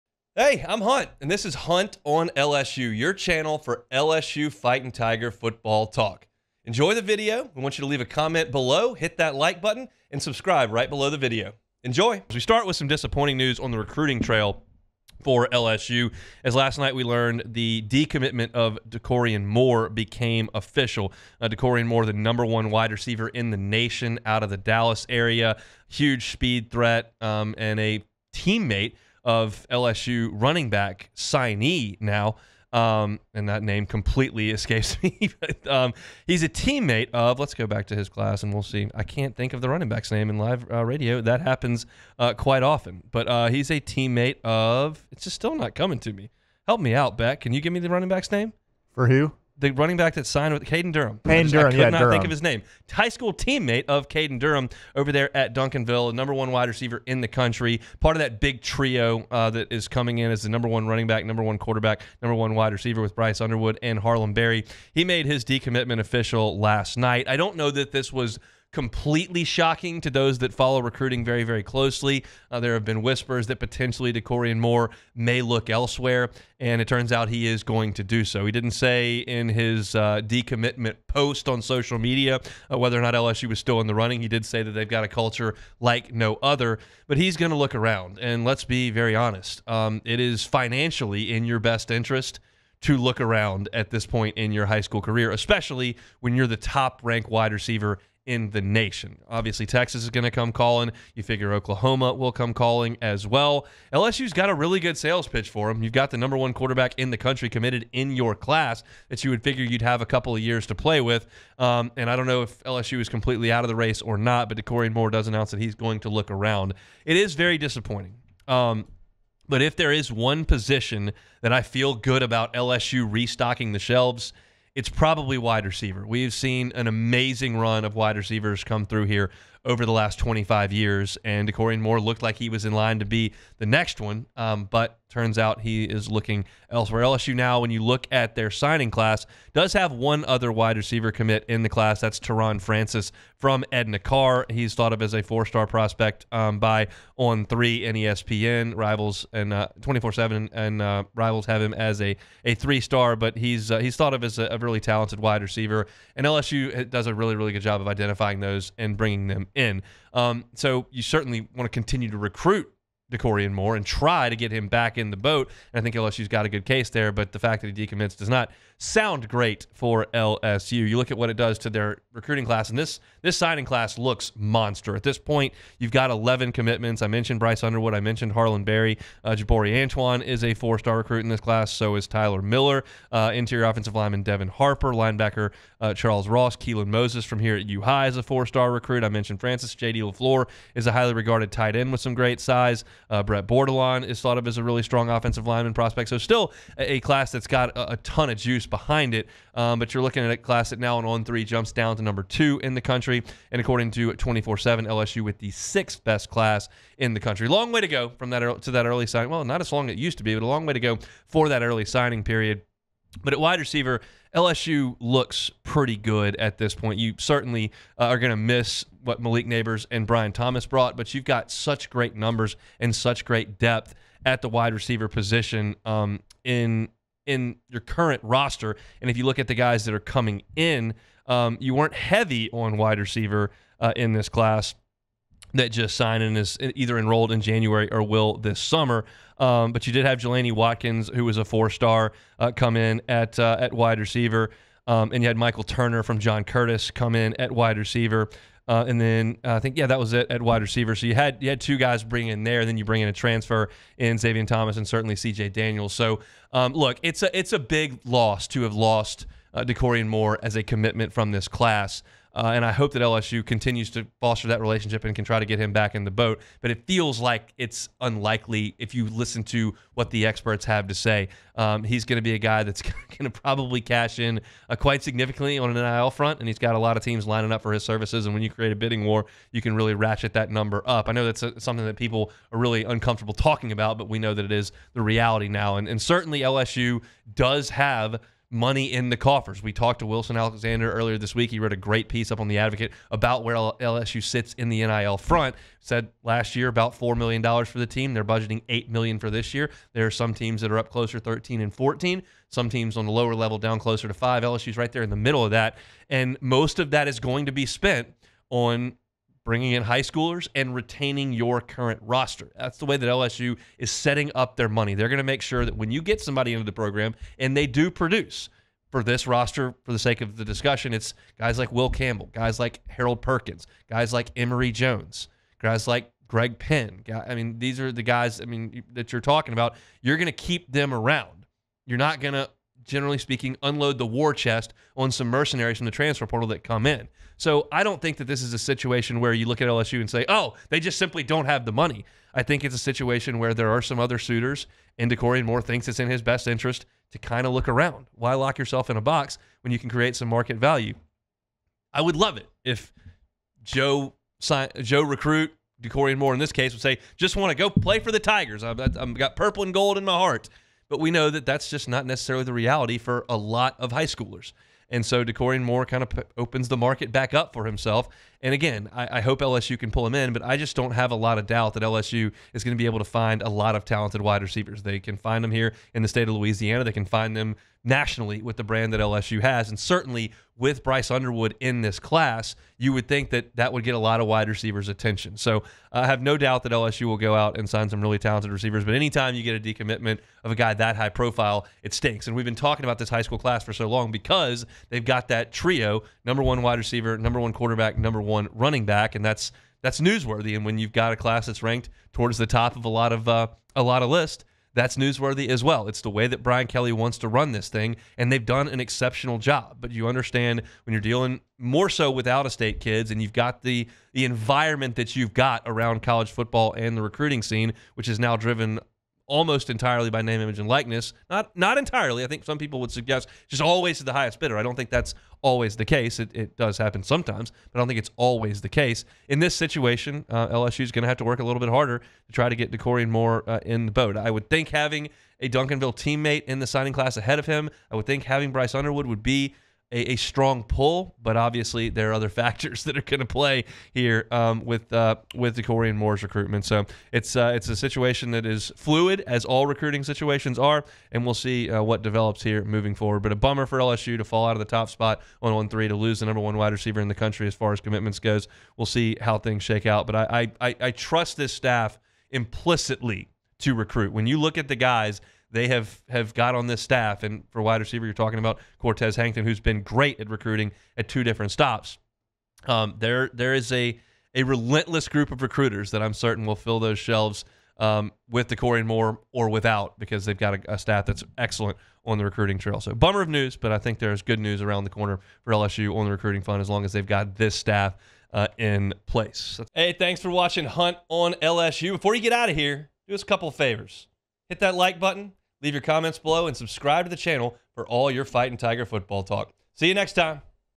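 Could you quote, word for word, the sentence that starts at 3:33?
But at wide receiver, LSU looks pretty good at this point.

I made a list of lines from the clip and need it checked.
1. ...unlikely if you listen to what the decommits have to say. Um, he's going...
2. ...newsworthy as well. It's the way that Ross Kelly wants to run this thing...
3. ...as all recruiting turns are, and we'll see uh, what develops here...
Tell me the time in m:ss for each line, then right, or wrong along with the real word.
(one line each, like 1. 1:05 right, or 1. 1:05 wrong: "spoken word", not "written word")
1. 4:27 wrong: "experts", not "decommits"
2. 6:44 wrong: "Brian", not "Ross"
3. 7:29 wrong: "situations", not "turns".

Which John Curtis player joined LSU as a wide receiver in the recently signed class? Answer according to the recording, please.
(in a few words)
Michael Turner.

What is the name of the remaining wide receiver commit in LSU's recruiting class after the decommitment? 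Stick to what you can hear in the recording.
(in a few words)
Teron Francis.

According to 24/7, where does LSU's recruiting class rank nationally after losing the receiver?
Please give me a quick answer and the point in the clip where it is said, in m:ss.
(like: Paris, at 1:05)
6th, at 3:25.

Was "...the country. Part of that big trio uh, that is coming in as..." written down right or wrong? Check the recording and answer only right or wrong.
right.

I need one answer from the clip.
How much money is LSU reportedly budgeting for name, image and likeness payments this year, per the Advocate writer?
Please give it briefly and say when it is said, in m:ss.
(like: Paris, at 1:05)
$8 million, at 4:58.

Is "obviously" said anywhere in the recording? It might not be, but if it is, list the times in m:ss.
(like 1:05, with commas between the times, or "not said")
1:39, 7:21.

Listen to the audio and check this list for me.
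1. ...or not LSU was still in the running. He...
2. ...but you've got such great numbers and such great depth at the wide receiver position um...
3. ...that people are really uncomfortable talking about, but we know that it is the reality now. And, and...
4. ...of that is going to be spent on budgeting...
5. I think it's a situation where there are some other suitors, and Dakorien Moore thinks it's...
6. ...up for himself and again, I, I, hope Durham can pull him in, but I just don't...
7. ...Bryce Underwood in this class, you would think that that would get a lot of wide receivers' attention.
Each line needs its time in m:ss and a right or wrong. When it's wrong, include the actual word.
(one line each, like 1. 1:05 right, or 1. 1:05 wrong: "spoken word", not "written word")
1. 1:22 right
2. 3:40 right
3. 4:41 right
4. 5:06 wrong: "bringing", not "budgeting"
5. 5:42 right
6. 6:07 wrong: "LSU", not "Durham"
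7. 6:20 right.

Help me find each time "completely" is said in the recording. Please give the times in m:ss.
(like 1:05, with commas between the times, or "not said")
0:33, 1:08, 1:53.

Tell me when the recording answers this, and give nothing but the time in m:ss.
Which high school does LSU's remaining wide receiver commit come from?
2:23.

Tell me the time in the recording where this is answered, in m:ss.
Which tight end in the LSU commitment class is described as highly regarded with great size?
3:09.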